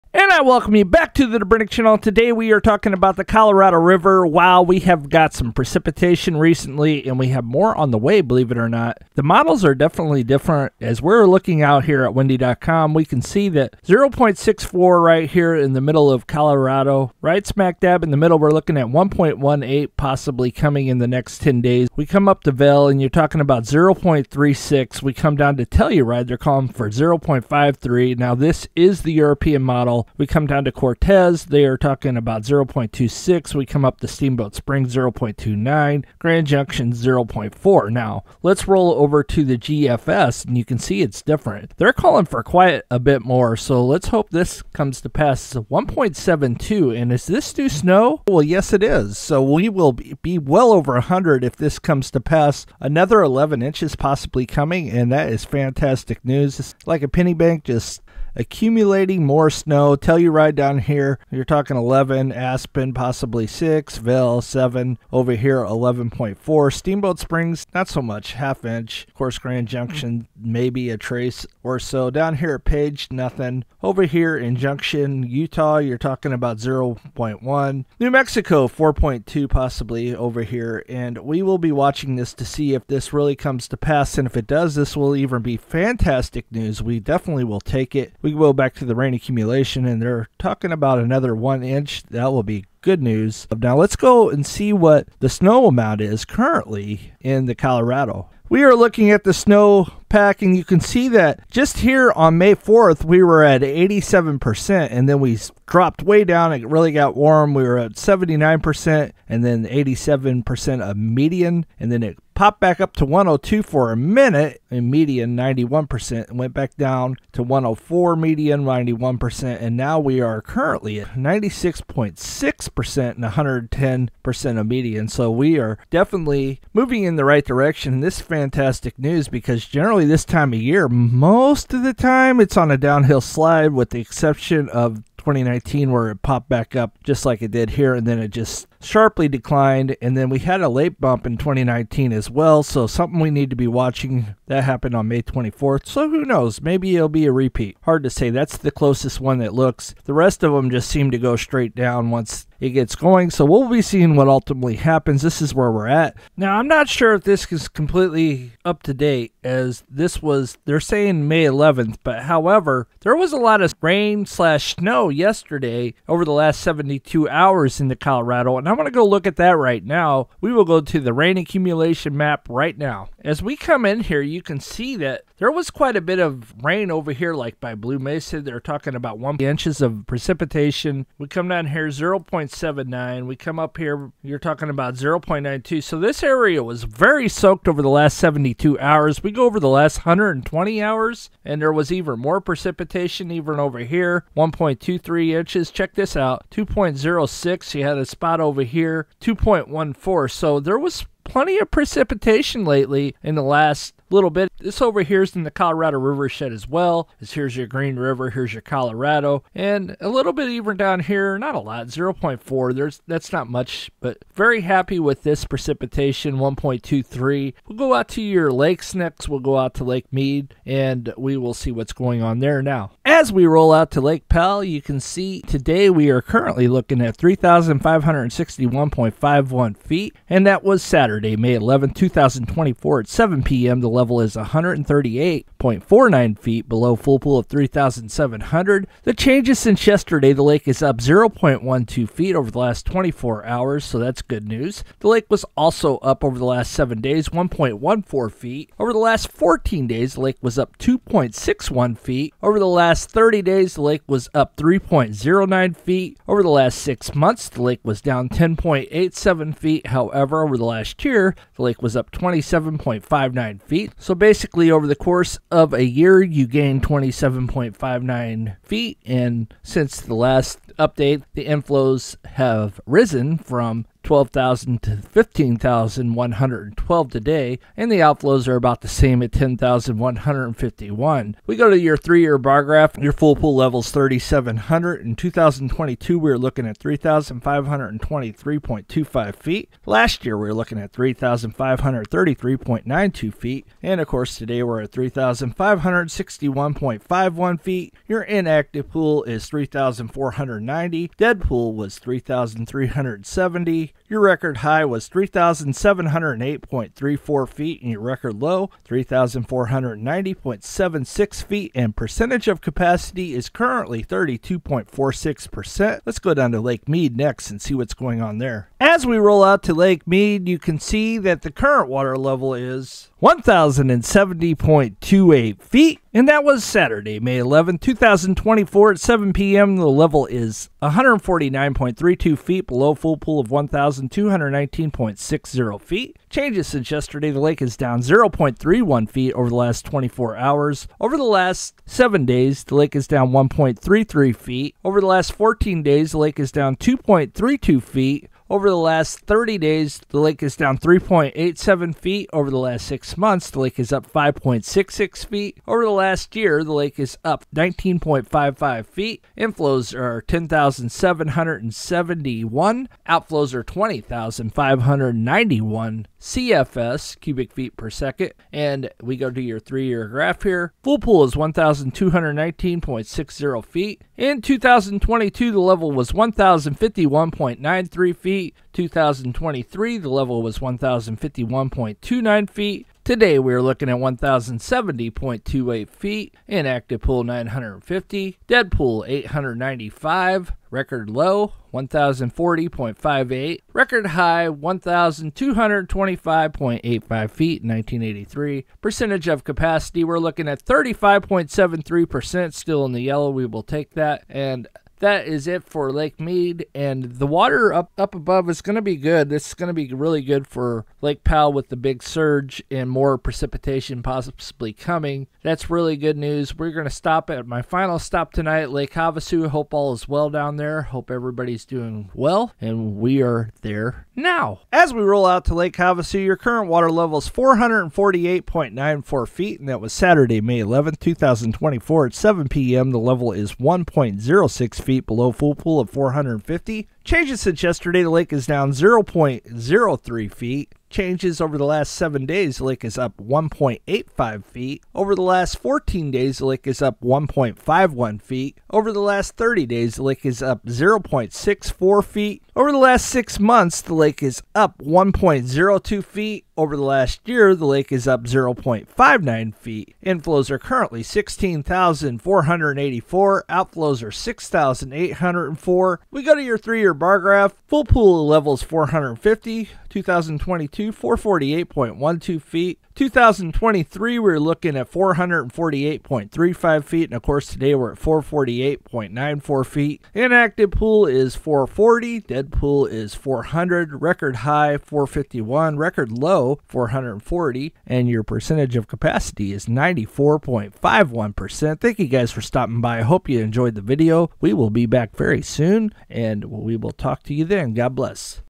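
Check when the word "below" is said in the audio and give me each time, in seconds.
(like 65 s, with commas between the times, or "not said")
236 s, 332 s, 435 s.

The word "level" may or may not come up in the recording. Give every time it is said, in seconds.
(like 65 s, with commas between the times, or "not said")
233 s, 322 s, 329 s, 380 s, 426 s, 432 s.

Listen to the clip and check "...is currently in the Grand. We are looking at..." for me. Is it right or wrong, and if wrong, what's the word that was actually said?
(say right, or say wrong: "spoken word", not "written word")
wrong: "Colorado", not "Grand".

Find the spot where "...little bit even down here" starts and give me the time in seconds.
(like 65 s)
210 s.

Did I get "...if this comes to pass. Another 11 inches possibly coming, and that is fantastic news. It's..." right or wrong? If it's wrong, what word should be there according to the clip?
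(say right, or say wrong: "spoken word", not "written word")
right.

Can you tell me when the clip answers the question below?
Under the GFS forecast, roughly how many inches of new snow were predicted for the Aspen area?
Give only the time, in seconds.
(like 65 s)
62 s.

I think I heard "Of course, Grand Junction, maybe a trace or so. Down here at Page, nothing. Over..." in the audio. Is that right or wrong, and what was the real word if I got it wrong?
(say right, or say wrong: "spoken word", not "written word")
right.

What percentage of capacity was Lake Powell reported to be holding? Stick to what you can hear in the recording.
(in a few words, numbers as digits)
32.46%.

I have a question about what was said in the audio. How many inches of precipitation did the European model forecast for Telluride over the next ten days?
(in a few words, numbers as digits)
0.53.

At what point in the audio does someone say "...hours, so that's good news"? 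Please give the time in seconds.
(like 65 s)
243 s.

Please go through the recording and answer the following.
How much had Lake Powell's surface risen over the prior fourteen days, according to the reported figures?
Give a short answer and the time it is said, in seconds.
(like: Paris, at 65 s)
2.61 feet, at 250 s.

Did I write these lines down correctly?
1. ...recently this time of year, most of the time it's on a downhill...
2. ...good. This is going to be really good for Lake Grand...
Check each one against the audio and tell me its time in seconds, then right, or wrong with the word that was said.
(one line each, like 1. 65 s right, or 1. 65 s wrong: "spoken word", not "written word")
1. 129 s wrong: "generally", not "recently"
2. 408 s wrong: "Powell", not "Grand".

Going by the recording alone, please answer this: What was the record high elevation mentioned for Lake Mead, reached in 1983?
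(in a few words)
1,225.85 feet.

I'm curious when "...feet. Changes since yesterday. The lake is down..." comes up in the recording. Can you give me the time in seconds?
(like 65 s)
335 s.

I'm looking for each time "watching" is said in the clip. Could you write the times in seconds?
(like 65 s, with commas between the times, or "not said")
81 s, 143 s.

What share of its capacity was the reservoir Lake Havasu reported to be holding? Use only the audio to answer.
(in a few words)
94.51%.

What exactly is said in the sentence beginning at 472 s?
2023, we are looking at 448.35 feet, and of course, today we're at 448.94 feet.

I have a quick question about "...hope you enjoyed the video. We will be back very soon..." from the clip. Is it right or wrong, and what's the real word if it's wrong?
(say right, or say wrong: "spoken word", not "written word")
right.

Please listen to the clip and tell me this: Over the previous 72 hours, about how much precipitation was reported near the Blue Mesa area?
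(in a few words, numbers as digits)
one inch.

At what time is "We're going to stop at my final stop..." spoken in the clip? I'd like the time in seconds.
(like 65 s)
416 s.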